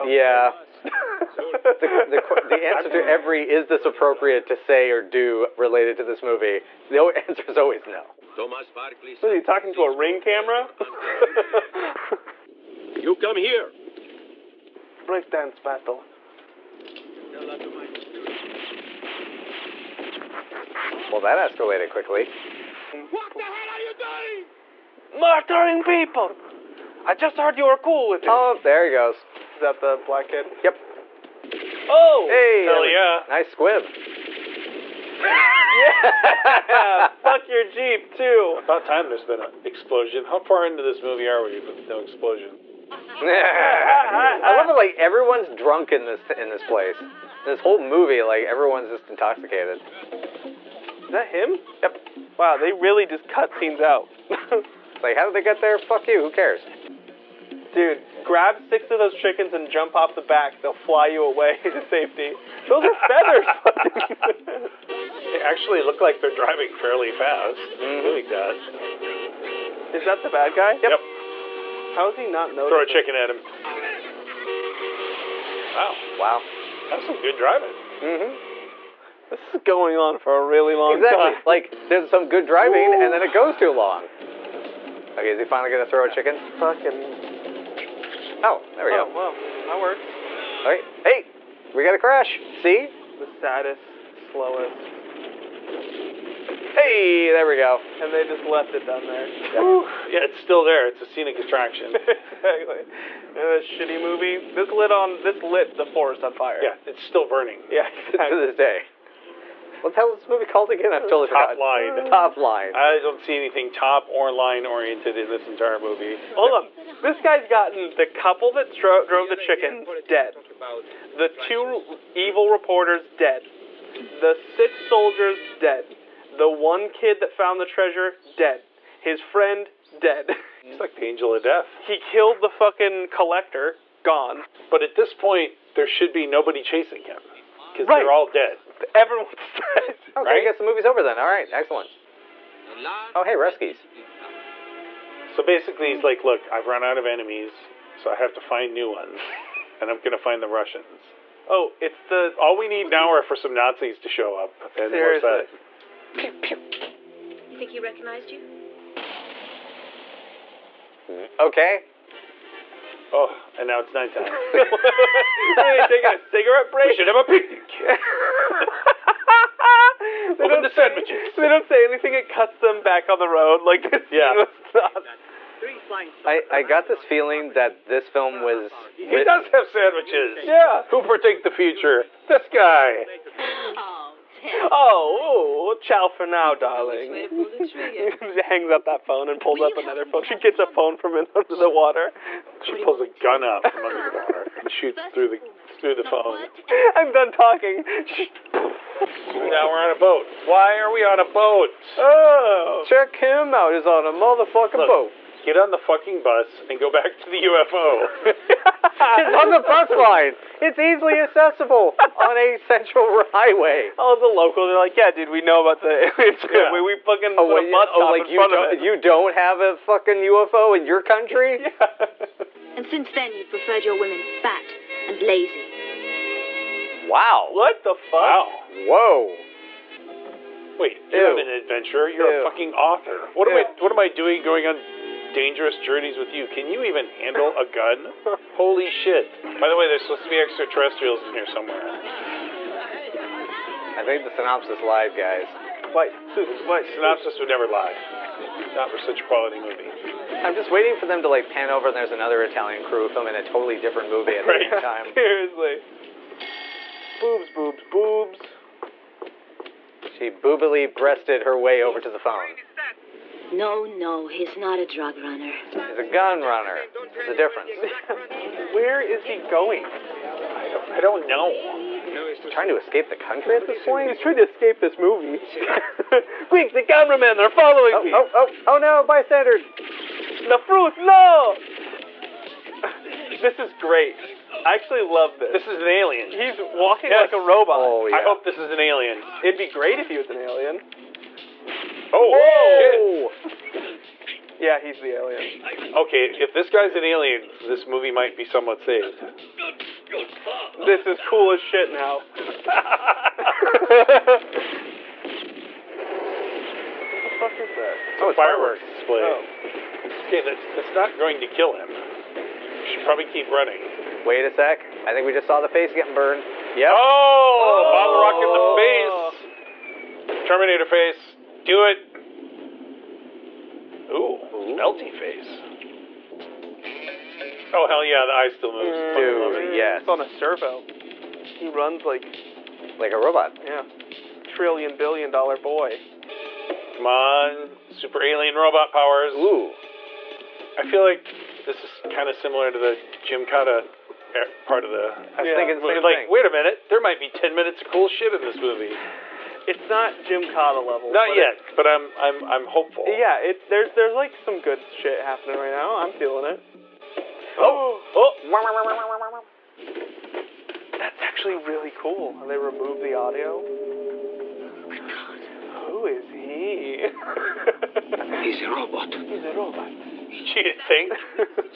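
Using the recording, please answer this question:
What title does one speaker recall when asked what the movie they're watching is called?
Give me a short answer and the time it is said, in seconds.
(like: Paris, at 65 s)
Top Line, at 112 s.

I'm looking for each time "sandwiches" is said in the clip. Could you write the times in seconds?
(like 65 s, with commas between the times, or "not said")
170 s, 179 s.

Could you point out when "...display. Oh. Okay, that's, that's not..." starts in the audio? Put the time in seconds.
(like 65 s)
309 s.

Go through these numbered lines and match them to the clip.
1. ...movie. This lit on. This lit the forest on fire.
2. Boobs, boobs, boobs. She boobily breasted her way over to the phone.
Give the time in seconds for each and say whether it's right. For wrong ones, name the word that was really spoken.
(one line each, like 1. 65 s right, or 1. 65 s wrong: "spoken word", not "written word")
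1. 104 s right
2. 257 s right.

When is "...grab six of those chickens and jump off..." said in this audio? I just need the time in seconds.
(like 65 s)
58 s.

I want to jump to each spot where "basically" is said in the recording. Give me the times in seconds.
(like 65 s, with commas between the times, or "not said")
145 s.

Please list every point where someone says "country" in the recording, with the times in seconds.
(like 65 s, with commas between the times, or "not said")
221 s, 273 s.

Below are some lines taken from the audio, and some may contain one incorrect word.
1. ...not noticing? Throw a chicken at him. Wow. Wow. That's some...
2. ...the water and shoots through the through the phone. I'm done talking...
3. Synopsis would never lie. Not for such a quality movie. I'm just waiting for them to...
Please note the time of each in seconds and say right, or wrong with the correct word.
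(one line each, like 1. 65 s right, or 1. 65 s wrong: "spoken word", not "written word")
1. 72 s right
2. 194 s right
3. 246 s right.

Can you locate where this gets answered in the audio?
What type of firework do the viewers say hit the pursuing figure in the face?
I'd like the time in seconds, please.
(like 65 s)
317 s.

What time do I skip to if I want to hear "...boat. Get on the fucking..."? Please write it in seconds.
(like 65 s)
204 s.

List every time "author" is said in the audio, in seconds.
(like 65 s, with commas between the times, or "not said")
232 s.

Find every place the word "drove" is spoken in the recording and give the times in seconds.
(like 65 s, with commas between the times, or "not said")
119 s.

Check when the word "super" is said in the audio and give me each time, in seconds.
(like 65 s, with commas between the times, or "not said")
337 s.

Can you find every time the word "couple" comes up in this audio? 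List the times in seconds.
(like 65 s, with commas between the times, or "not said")
118 s.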